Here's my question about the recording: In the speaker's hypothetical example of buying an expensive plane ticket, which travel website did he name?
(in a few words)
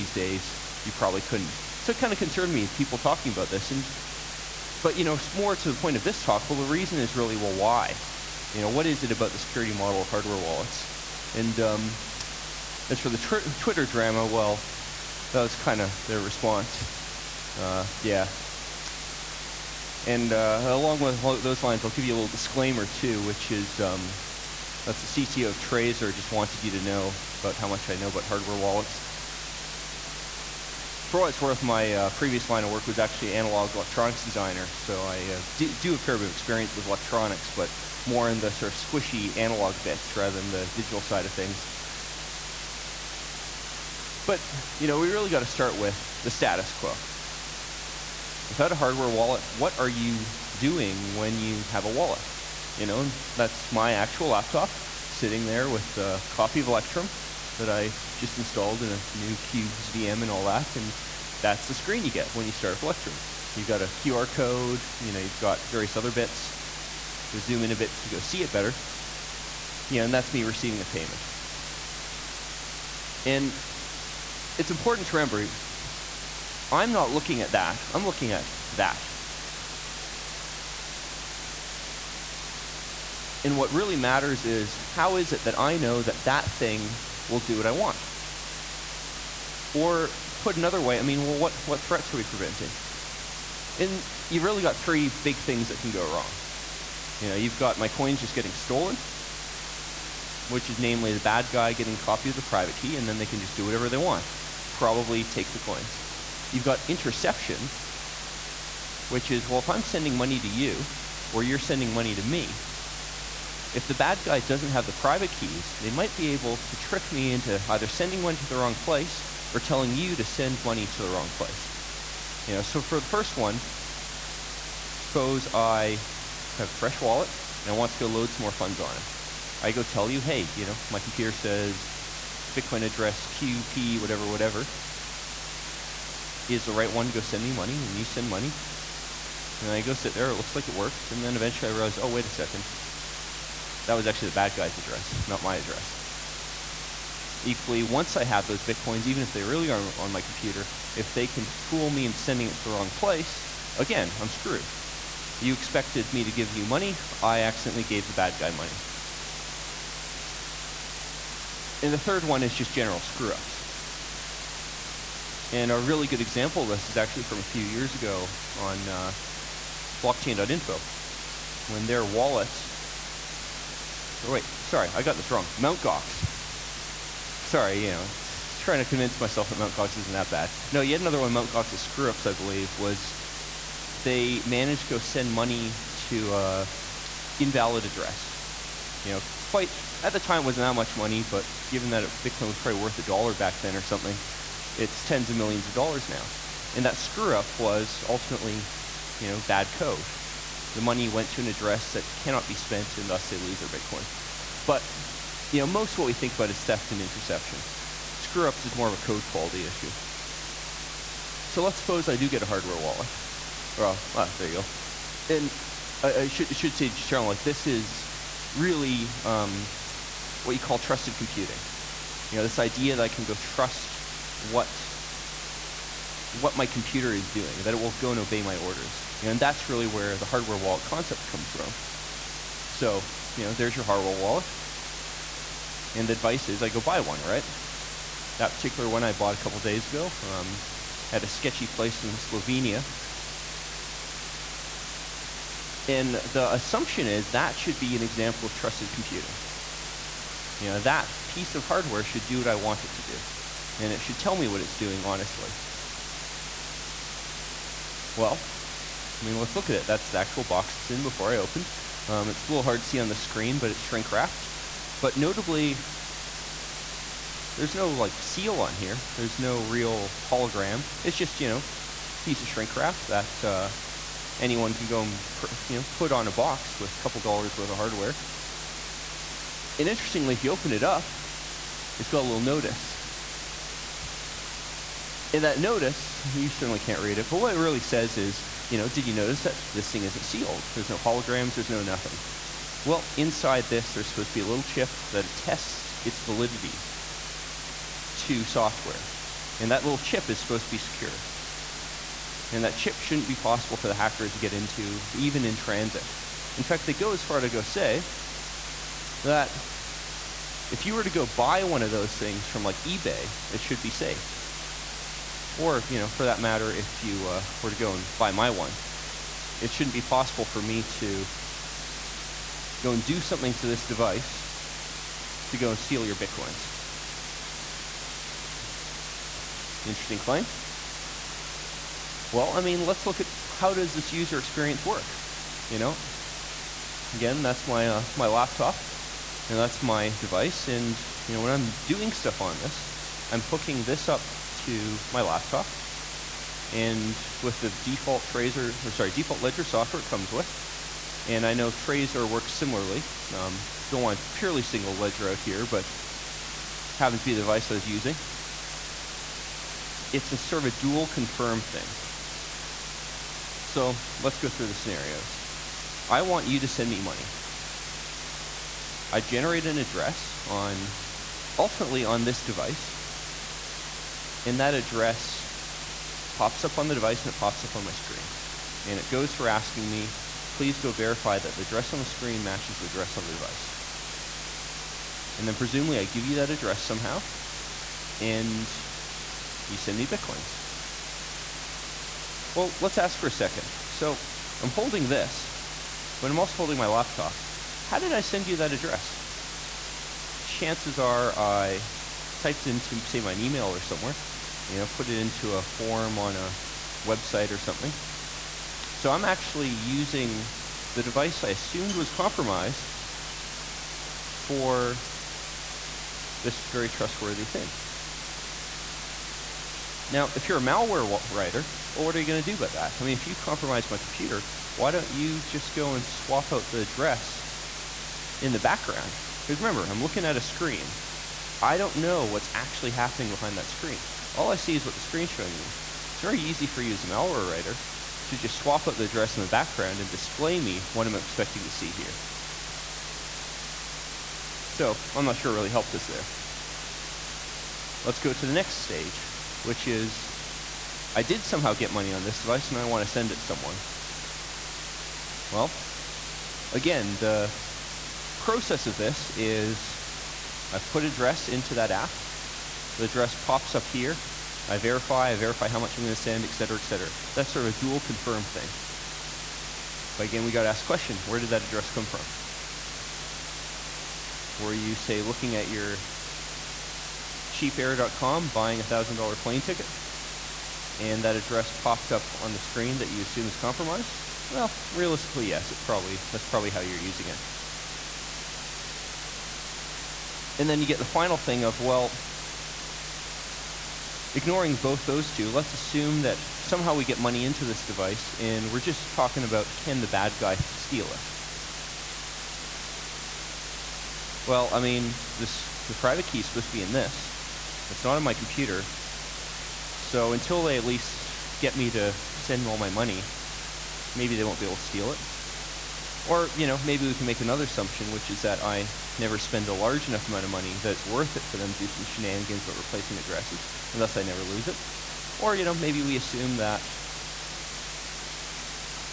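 cheapair.com.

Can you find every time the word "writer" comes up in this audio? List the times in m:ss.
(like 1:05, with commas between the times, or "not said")
7:01, 7:17.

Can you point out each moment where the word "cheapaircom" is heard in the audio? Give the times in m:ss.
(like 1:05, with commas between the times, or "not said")
7:57.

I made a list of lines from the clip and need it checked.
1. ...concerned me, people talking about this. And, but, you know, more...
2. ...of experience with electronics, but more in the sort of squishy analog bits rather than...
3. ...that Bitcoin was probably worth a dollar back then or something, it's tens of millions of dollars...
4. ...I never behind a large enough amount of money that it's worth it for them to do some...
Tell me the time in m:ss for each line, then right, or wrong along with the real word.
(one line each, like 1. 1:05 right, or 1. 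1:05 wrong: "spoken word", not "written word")
1. 0:02 right
2. 0:36 right
3. 3:11 right
4. 8:38 wrong: "spend", not "behind".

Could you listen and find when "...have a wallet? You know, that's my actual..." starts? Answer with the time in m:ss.
0:51.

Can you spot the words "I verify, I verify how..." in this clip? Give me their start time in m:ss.
7:44.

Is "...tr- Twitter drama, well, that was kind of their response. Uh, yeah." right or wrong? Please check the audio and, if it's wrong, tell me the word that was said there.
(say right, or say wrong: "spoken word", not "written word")
right.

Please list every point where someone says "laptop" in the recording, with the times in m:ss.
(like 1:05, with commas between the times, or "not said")
0:54, 5:38, 5:45, 6:36.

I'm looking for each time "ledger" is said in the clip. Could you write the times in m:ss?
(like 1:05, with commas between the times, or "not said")
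5:49, 5:54.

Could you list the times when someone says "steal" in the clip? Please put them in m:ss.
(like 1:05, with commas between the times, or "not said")
5:25, 8:20, 8:34.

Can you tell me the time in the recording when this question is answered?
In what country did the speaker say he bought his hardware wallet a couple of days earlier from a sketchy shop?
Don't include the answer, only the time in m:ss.
4:02.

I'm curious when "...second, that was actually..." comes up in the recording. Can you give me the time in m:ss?
2:22.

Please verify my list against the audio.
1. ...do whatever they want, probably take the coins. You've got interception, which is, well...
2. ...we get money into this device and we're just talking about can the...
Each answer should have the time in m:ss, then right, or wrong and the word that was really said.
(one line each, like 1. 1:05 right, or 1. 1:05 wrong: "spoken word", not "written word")
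1. 1:43 right
2. 8:16 right.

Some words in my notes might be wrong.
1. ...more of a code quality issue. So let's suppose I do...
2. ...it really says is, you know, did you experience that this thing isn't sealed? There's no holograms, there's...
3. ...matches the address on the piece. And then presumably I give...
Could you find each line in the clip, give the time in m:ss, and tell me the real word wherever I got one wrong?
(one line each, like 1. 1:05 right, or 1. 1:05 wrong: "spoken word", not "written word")
1. 3:28 right
2. 4:47 wrong: "notice", not "experience"
3. 6:22 wrong: "device", not "piece".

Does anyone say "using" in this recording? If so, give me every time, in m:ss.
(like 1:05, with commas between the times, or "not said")
5:57, 6:49, 8:06.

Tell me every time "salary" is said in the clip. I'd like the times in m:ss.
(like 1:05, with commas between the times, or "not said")
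not said.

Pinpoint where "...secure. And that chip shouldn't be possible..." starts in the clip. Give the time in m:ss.
5:00.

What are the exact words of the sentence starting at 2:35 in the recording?
You expected me to give you money, I accidentally gave the bad guy money.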